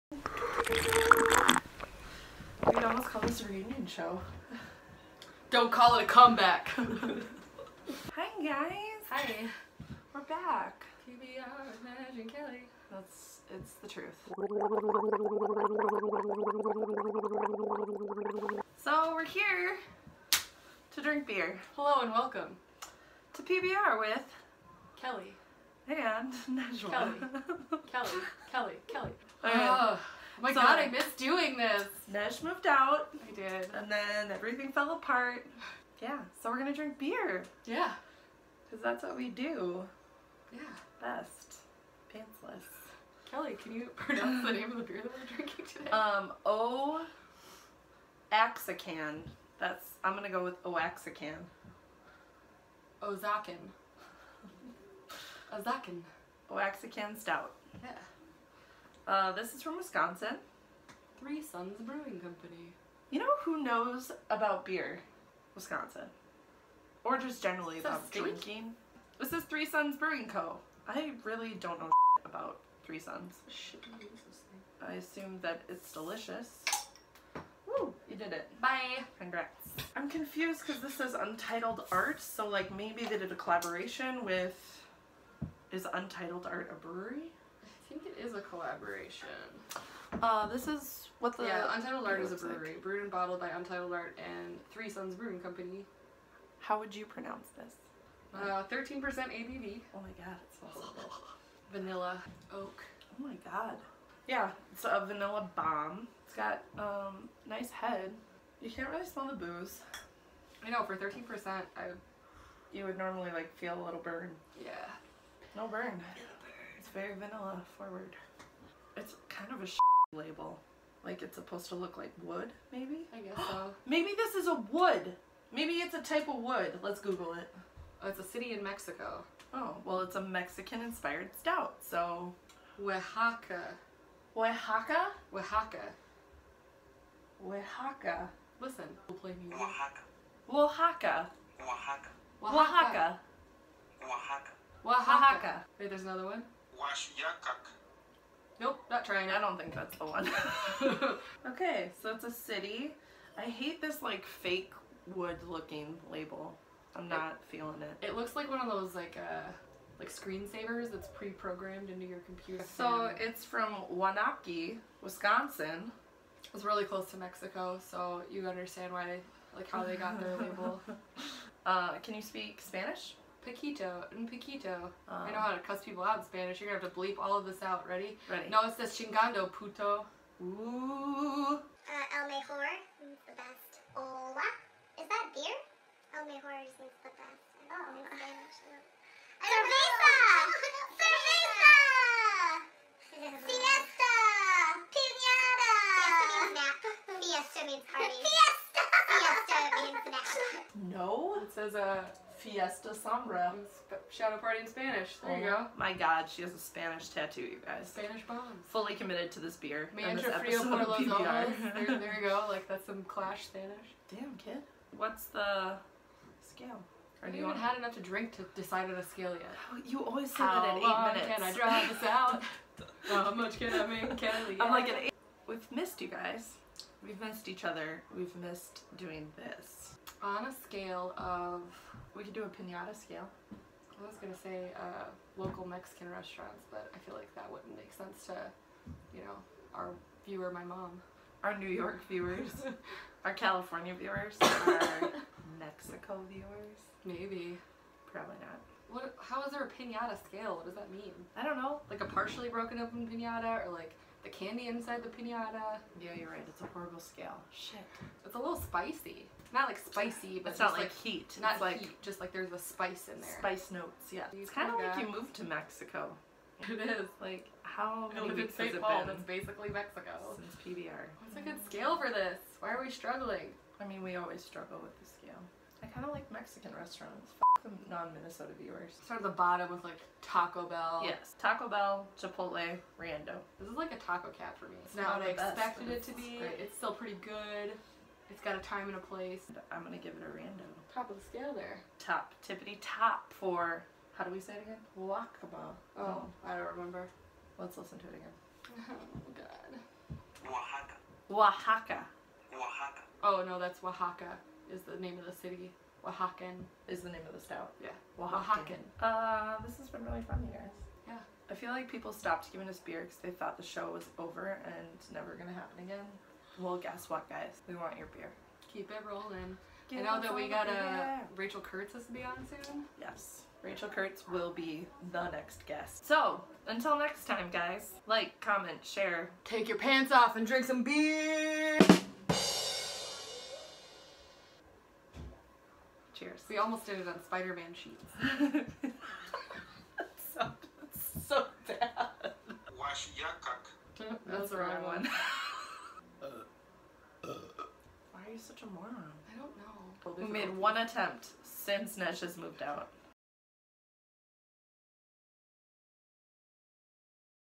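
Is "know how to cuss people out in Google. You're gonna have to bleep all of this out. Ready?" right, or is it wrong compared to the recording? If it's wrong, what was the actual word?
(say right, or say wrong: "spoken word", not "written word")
wrong: "Spanish", not "Google".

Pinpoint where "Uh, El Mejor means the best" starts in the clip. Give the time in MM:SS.
03:01.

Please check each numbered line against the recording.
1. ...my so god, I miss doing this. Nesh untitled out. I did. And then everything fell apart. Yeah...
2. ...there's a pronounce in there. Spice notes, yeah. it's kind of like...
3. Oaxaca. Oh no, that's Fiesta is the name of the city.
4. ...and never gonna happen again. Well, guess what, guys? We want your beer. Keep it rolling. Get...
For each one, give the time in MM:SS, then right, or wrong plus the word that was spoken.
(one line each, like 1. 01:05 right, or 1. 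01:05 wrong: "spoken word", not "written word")
1. 00:30 wrong: "moved", not "untitled"
2. 04:22 wrong: "spice", not "pronounce"
3. 05:02 wrong: "Oaxaca", not "Fiesta"
4. 05:14 right.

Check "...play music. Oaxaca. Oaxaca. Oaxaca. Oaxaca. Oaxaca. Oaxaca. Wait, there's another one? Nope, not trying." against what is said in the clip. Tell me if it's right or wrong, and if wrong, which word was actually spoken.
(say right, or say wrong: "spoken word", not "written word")
right.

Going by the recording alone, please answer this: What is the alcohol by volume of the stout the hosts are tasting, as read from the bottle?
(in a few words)
13%.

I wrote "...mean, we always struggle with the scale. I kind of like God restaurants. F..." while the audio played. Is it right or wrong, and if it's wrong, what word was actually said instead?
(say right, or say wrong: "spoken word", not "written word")
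wrong: "Mexican", not "God".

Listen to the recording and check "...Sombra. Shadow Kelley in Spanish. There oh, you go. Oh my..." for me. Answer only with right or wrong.
wrong.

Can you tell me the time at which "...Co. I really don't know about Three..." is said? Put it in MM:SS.
01:10.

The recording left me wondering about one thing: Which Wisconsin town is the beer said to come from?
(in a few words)
Waunakee.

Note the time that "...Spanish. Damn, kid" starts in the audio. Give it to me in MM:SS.
03:33.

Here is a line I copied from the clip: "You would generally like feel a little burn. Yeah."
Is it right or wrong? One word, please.
wrong.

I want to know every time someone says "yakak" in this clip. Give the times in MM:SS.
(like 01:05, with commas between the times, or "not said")
05:43.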